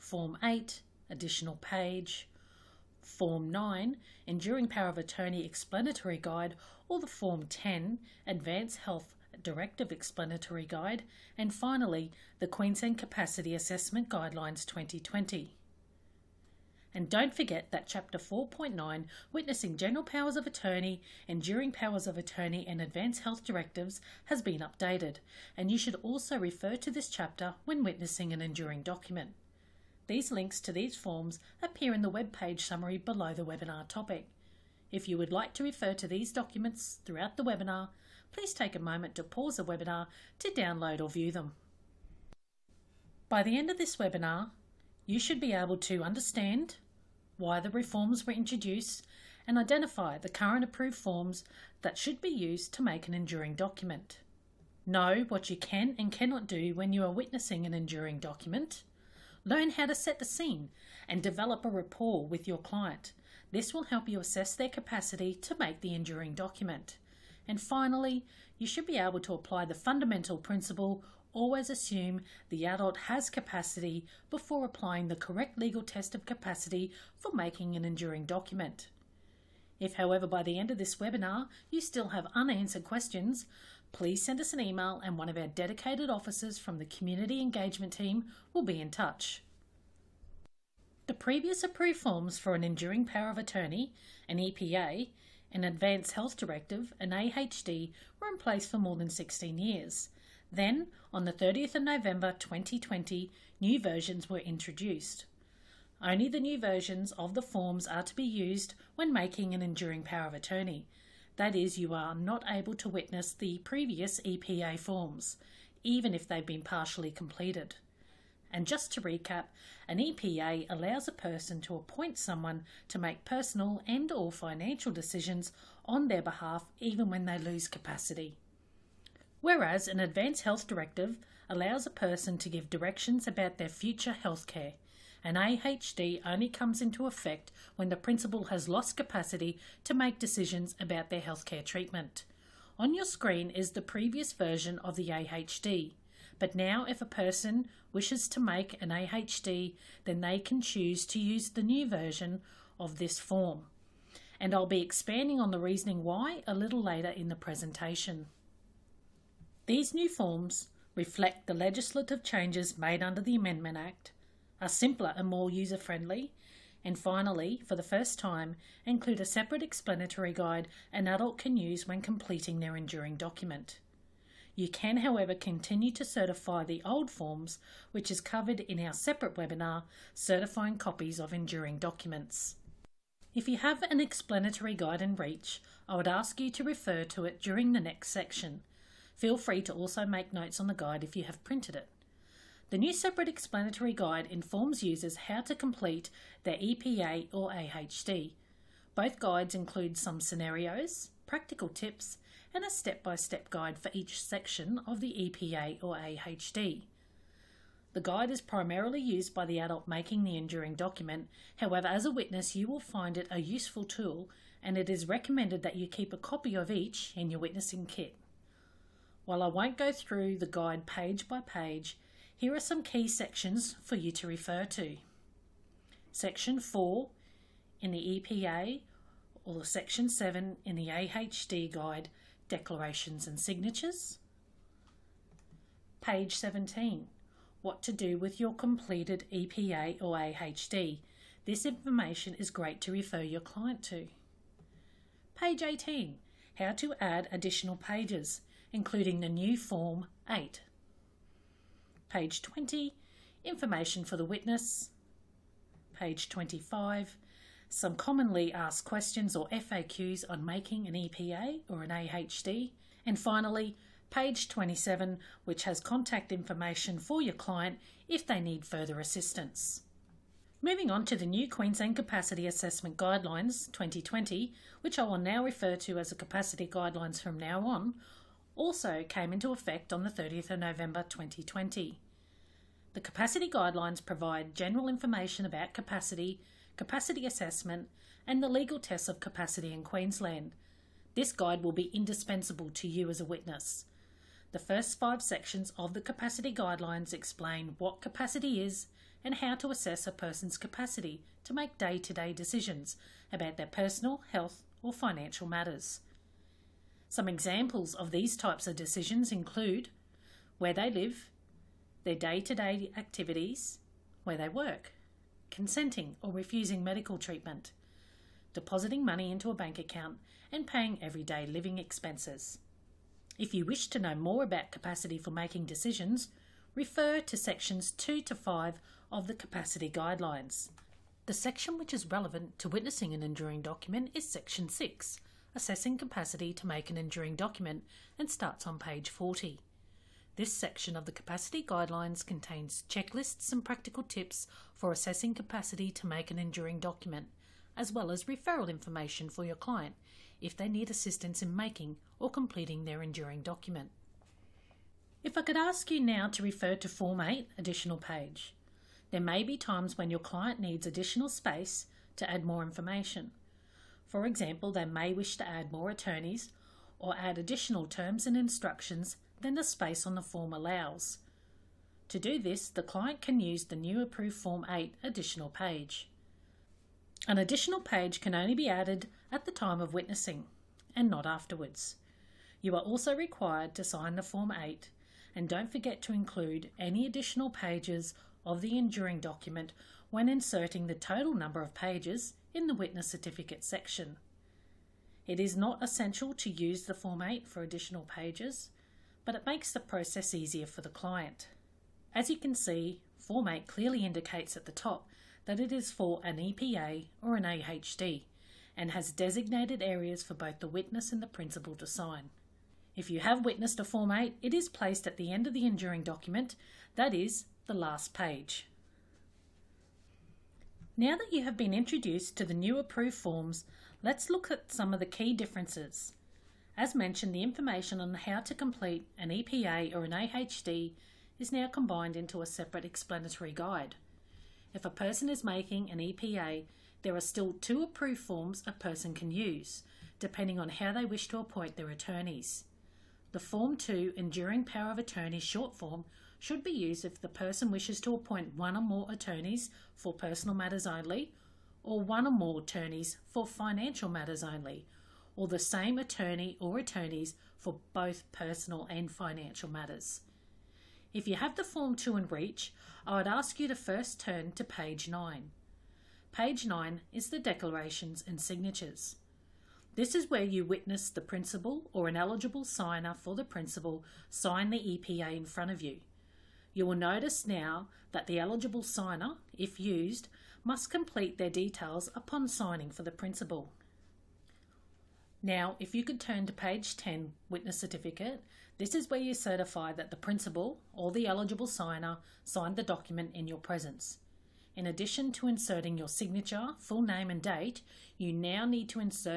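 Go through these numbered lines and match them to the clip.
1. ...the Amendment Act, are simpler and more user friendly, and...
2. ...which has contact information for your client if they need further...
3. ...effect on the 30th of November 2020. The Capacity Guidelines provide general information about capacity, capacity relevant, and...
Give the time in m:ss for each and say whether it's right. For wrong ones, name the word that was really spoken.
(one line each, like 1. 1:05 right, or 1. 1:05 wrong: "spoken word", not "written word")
1. 2:43 right
2. 4:25 right
3. 4:39 wrong: "assessment", not "relevant".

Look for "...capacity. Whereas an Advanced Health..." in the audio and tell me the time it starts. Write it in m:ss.
2:07.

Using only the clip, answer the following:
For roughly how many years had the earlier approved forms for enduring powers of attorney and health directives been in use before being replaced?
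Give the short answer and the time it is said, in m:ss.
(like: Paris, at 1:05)
16 years, at 1:39.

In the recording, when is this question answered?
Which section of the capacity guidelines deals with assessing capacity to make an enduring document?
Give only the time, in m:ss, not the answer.
5:34.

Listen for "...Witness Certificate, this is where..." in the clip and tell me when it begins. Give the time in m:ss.
8:07.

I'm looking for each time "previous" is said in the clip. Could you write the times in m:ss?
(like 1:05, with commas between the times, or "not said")
1:31, 1:53, 2:23.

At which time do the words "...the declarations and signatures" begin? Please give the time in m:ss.
7:47.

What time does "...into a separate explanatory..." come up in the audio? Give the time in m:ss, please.
7:12.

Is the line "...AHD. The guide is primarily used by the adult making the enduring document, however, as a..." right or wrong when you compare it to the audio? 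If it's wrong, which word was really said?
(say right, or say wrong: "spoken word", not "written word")
right.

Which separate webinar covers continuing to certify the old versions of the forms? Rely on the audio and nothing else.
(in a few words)
Certifying Copies of Enduring Documents.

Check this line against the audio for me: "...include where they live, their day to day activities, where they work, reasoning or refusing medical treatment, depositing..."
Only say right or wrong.
wrong.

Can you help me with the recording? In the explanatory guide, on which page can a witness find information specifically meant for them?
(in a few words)
Page 20.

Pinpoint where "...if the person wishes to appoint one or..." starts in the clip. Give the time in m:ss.
7:27.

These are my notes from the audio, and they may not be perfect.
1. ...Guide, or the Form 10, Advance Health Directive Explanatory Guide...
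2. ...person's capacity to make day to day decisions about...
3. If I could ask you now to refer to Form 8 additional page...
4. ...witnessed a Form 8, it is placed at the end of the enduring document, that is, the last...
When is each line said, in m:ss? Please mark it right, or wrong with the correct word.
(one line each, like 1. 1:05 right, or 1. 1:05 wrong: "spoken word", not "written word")
1. 0:06 right
2. 5:00 right
3. 5:55 right
4. 6:53 right.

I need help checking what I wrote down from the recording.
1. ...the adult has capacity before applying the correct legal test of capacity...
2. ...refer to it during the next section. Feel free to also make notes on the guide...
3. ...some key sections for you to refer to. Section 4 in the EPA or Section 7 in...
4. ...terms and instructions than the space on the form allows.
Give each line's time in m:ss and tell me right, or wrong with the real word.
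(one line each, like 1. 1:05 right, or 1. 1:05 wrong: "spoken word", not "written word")
1. 1:12 right
2. 3:06 right
3. 3:42 right
4. 6:07 right.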